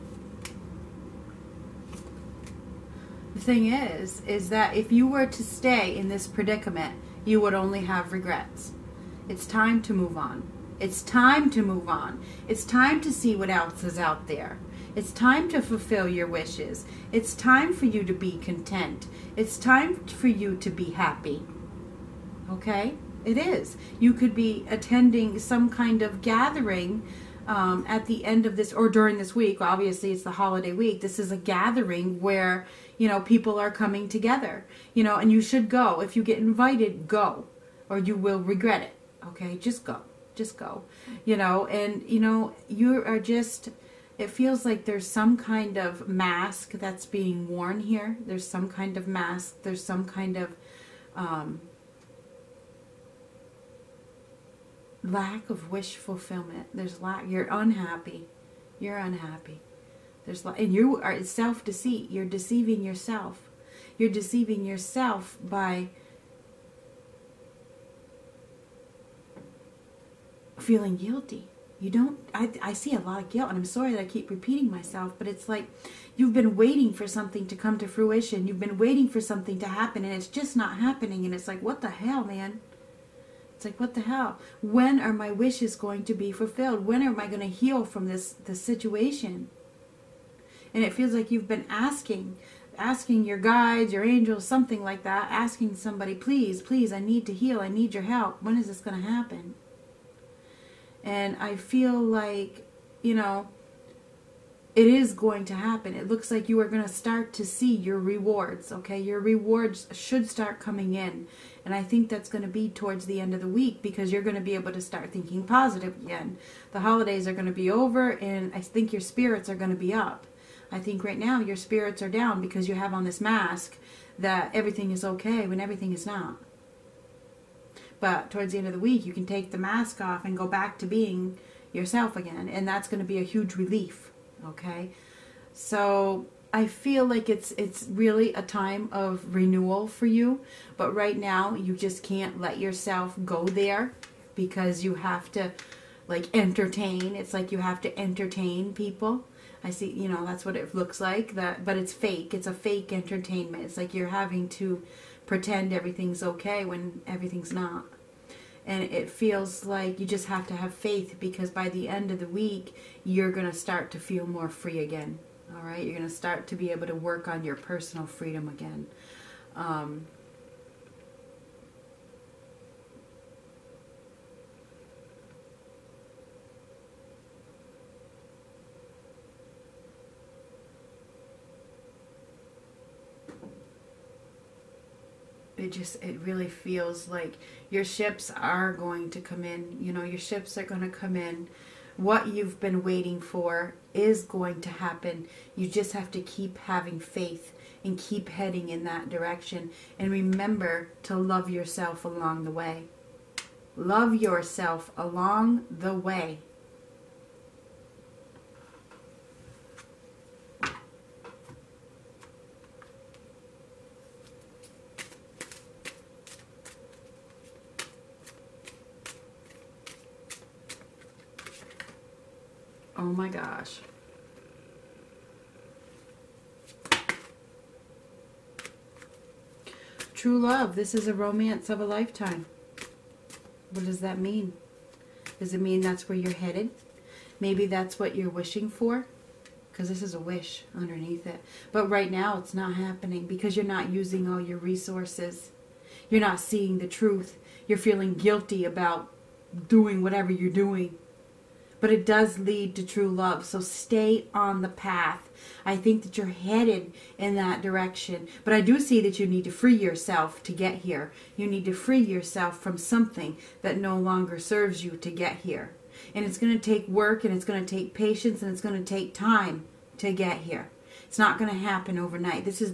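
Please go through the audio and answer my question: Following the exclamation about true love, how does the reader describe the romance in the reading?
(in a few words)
romance of a lifetime.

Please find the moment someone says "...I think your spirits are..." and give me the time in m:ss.
1:58.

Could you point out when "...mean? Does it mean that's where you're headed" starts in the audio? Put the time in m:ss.
3:54.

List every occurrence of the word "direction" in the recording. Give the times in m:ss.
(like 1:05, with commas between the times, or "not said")
3:19, 4:17.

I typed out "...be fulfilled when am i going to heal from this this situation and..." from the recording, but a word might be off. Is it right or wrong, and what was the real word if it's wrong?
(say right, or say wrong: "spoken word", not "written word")
right.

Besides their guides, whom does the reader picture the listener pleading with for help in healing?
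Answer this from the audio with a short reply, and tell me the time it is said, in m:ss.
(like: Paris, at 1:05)
angels, at 1:34.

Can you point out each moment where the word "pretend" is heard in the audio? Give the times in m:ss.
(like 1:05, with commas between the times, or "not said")
2:35.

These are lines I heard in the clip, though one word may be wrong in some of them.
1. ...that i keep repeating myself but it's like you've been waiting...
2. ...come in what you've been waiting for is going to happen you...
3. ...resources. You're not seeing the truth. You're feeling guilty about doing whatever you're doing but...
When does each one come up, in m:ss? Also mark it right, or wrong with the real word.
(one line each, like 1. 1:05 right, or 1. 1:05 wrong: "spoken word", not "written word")
1. 1:13 right
2. 3:10 right
3. 4:04 right.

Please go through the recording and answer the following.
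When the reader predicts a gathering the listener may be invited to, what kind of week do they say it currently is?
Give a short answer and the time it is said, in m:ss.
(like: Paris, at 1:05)
holiday week, at 0:30.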